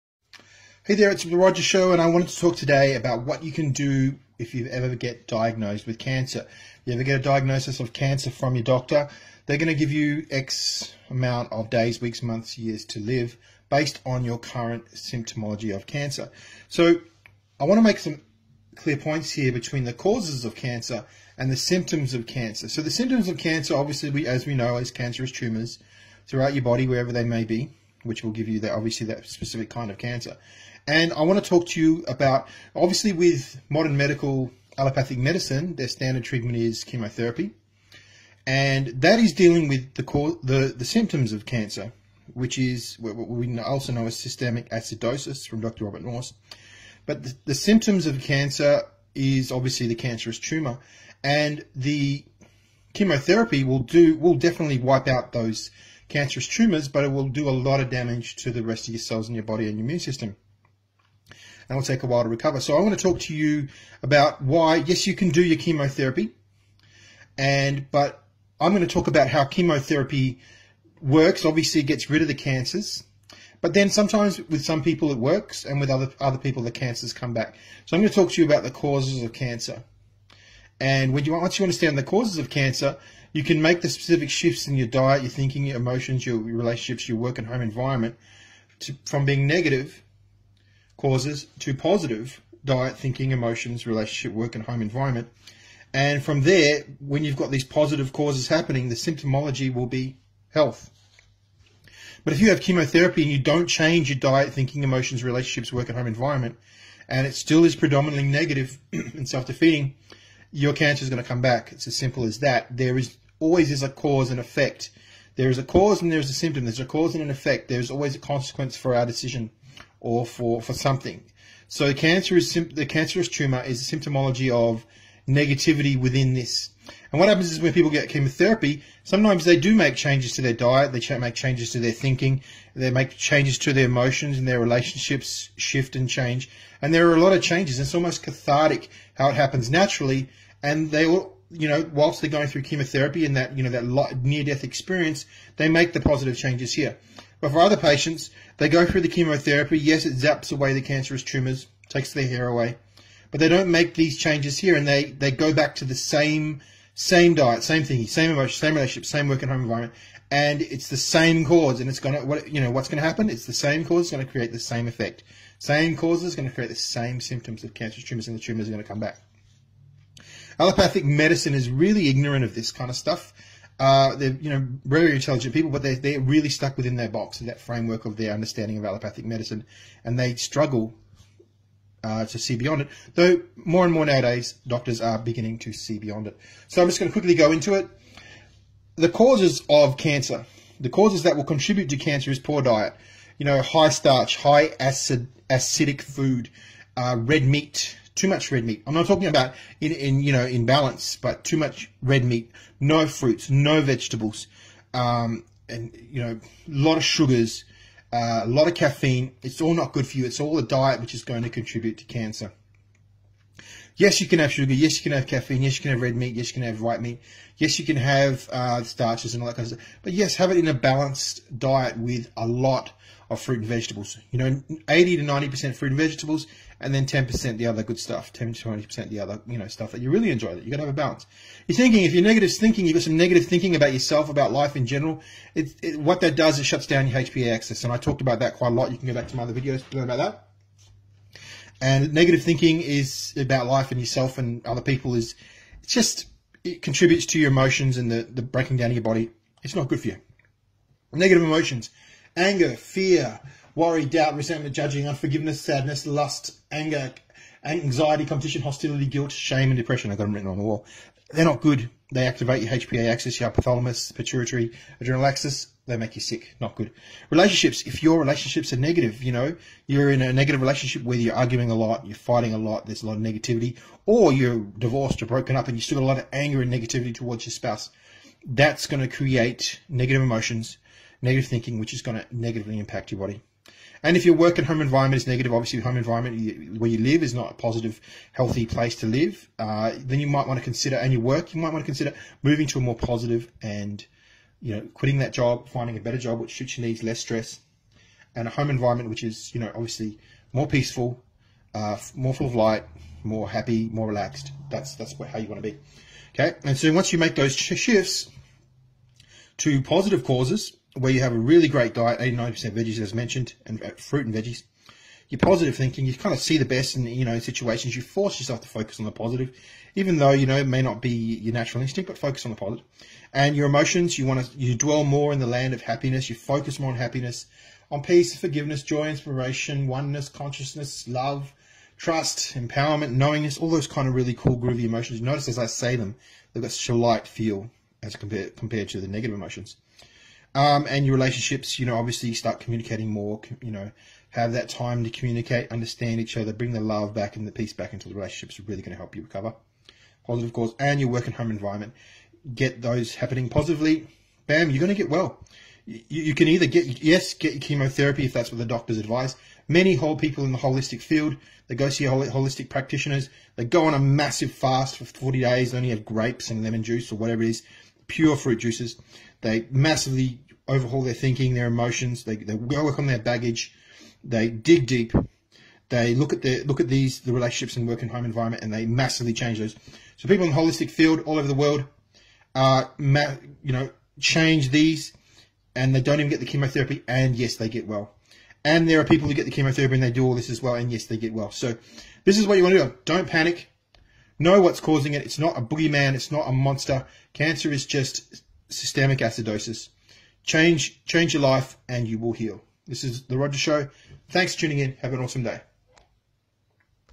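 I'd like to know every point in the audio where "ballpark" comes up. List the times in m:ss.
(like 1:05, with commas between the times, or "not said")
not said.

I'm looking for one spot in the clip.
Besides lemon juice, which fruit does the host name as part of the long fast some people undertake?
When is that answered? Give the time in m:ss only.
6:06.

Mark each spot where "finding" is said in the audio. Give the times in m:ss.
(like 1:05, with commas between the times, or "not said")
4:55.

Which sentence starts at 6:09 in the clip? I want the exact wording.
They massively overhaul their thinking, their emotions.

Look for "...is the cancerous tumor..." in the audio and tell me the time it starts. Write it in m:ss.
2:02.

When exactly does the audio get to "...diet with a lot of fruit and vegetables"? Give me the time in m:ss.
3:41.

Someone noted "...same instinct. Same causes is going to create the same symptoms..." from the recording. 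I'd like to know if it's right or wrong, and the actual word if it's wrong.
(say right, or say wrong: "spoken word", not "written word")
wrong: "effect", not "instinct".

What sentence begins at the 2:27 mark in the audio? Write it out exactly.
But for other patients, they go through the chemotherapy.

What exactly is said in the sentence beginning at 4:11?
Negative emotions, anger, fear, worry, doubt, resentment, judging, unforgiveness, sadness, lust, anger, anxiety, competition, hostility, guilt, shame, and depression.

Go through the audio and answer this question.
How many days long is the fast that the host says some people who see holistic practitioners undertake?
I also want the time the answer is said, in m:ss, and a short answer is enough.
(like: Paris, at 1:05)
40 days, at 6:05.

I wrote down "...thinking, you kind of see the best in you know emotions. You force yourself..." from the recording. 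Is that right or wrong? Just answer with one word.
wrong.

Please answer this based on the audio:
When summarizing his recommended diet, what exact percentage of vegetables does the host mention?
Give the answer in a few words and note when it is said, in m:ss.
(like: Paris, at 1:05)
89%, at 5:12.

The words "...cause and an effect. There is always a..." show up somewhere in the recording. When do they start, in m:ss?
1:56.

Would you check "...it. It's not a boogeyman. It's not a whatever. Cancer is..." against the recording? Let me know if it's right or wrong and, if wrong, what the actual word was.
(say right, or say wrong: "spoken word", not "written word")
wrong: "monster", not "whatever".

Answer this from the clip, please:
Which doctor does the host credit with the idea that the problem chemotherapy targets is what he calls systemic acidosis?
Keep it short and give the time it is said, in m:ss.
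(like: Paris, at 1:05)
Robert Morse, at 0:45.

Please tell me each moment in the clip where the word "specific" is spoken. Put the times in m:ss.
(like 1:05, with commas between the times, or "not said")
0:29, 1:23.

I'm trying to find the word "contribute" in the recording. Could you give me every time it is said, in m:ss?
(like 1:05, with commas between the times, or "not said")
3:11, 3:31, 4:06.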